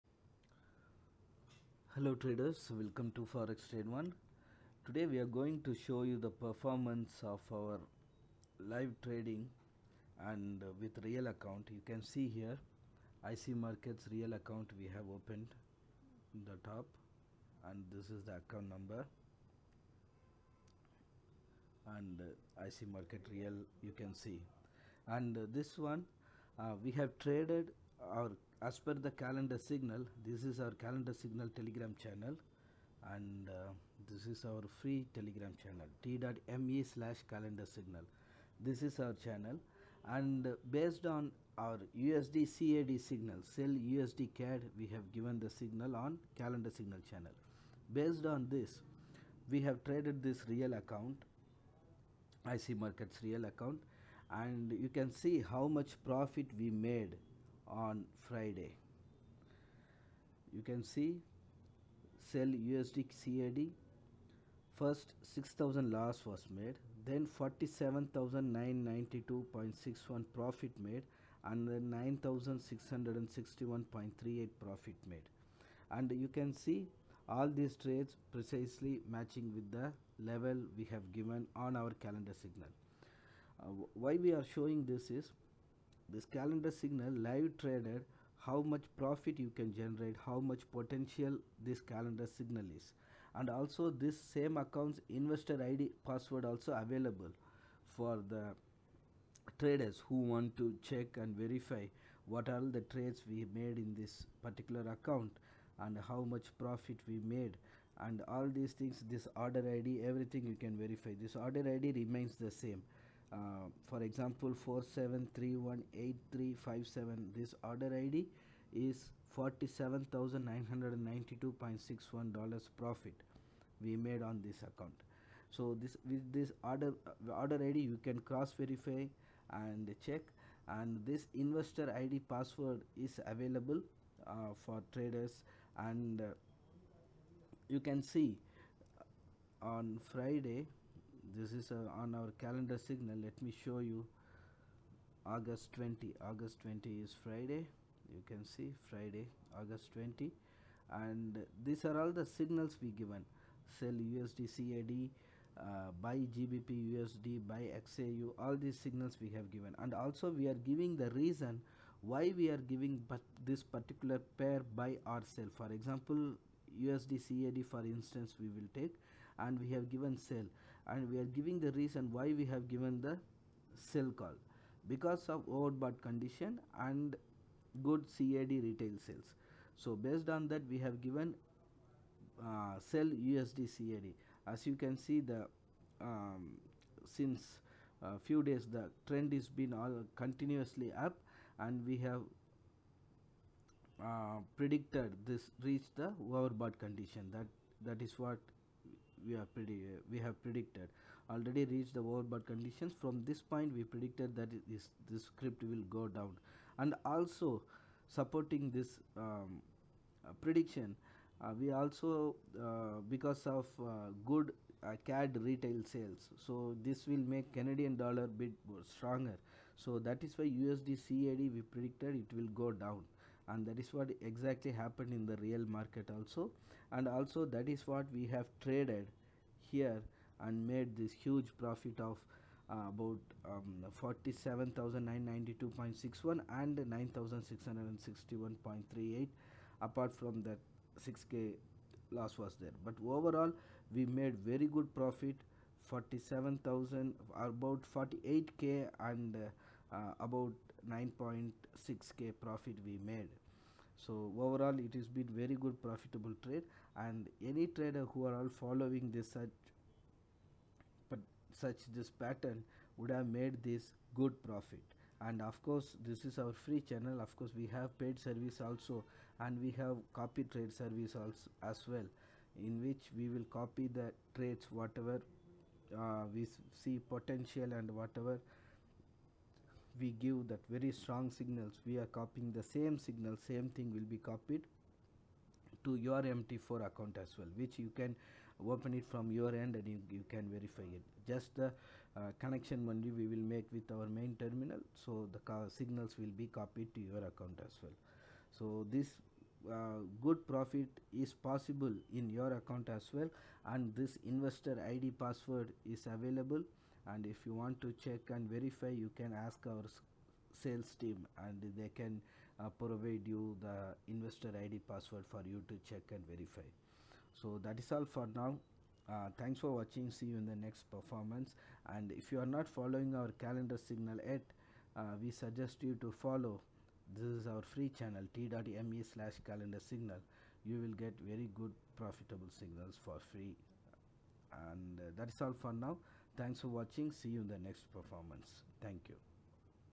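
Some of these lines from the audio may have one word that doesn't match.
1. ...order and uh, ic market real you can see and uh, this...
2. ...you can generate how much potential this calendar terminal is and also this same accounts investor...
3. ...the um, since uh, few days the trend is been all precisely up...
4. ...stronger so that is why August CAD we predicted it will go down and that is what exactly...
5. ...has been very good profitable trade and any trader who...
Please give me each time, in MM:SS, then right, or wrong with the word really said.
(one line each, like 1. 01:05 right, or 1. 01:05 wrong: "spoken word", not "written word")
1. 00:18 wrong: "number", not "order"
2. 01:29 wrong: "signal", not "terminal"
3. 03:05 wrong: "continuously", not "precisely"
4. 03:38 wrong: "USD", not "August"
5. 04:14 right.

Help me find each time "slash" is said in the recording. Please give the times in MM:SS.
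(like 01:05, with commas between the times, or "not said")
00:36, 05:29.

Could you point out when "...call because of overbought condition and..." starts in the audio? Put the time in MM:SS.
02:54.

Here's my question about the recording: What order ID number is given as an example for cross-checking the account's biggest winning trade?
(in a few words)
47318357.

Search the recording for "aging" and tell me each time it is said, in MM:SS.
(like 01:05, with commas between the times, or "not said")
not said.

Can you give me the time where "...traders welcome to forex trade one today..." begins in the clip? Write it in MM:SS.
00:02.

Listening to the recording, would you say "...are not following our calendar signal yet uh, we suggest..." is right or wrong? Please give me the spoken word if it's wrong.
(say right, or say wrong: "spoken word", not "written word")
right.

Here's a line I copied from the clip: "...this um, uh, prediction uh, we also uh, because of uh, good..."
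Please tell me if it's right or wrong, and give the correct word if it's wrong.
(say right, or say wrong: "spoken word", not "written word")
right.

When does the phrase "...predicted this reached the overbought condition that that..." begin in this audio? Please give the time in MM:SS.
03:14.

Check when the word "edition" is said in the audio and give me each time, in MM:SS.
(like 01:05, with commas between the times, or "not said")
not said.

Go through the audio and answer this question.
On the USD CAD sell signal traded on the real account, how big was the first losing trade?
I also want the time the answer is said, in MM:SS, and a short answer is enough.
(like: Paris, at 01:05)
6000, at 01:05.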